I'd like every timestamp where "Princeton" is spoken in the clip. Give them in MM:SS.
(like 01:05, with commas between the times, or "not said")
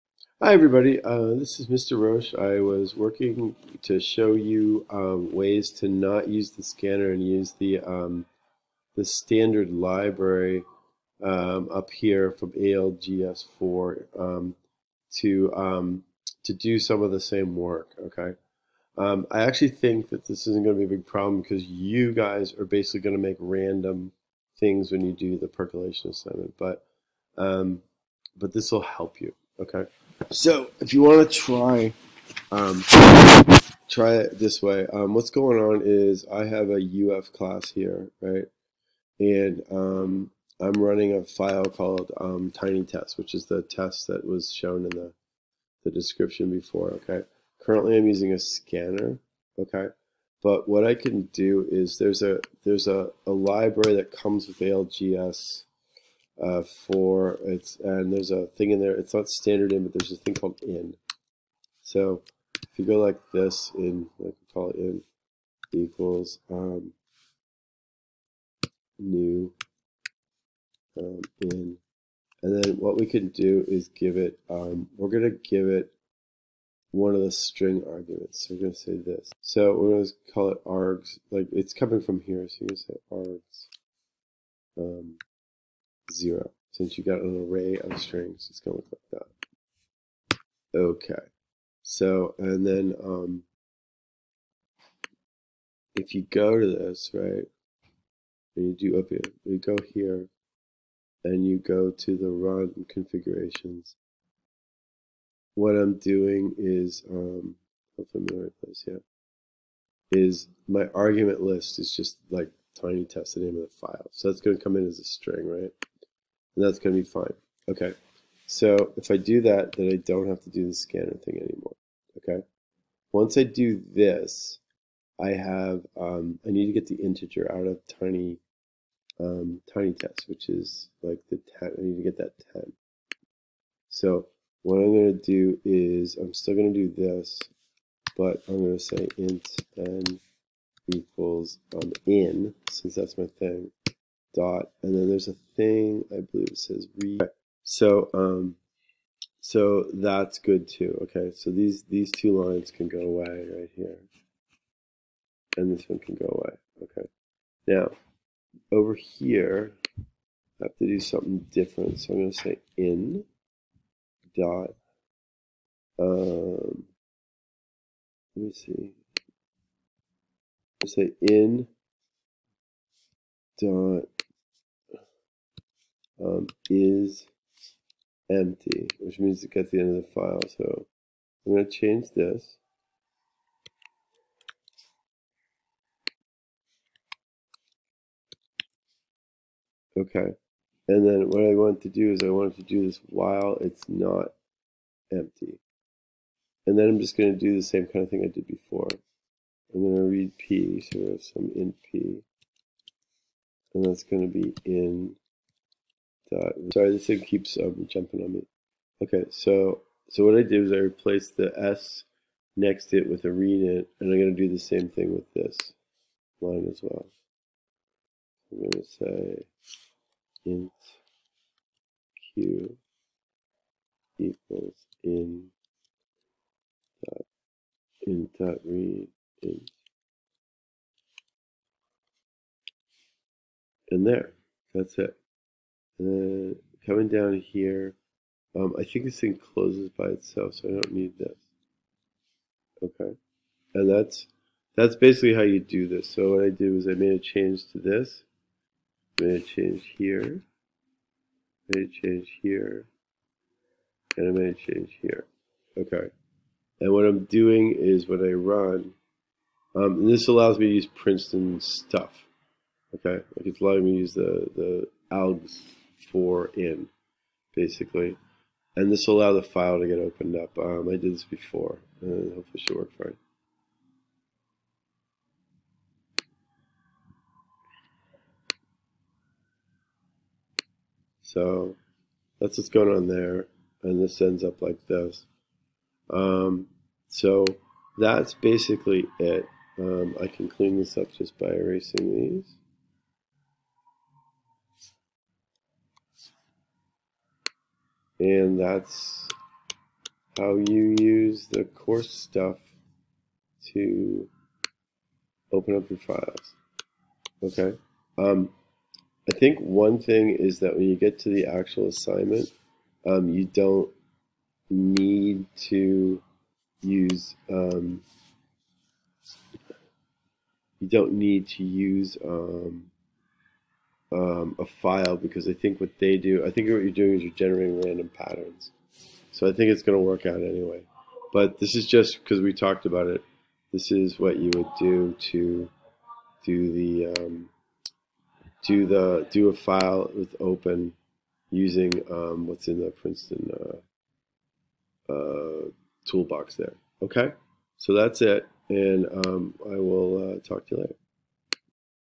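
04:20, 05:42.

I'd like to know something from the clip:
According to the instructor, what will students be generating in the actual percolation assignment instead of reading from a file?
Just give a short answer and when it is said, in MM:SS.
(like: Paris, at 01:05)
random patterns, at 05:27.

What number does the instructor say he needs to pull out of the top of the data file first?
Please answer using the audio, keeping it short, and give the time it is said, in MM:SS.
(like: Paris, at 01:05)
10, at 02:11.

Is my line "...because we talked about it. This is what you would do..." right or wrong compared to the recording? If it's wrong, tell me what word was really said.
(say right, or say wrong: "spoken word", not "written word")
right.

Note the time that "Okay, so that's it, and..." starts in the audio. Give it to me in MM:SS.
05:47.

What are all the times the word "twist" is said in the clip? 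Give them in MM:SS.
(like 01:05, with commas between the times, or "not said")
not said.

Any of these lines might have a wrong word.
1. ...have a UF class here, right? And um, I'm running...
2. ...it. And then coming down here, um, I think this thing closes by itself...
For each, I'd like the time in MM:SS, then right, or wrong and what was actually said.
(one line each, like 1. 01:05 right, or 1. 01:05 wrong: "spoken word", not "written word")
1. 00:36 right
2. 03:54 right.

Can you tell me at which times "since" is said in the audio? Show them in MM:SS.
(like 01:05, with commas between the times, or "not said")
01:26, 02:22.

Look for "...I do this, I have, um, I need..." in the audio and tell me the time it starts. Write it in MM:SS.
02:03.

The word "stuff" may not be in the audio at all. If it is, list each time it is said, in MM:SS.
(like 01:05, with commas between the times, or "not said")
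04:21, 05:02.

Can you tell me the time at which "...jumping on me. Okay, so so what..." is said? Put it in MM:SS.
03:27.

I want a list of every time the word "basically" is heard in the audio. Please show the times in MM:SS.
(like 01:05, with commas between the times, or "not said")
00:22, 04:04, 04:27, 04:48.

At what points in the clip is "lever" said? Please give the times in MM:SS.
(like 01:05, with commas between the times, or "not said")
not said.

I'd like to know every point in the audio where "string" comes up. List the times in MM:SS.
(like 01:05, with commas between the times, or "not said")
01:17, 01:27, 01:55.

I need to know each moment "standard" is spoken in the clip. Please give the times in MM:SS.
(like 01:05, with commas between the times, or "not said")
00:09, 00:59.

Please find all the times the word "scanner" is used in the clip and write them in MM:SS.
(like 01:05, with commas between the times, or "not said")
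00:06, 00:48, 02:00.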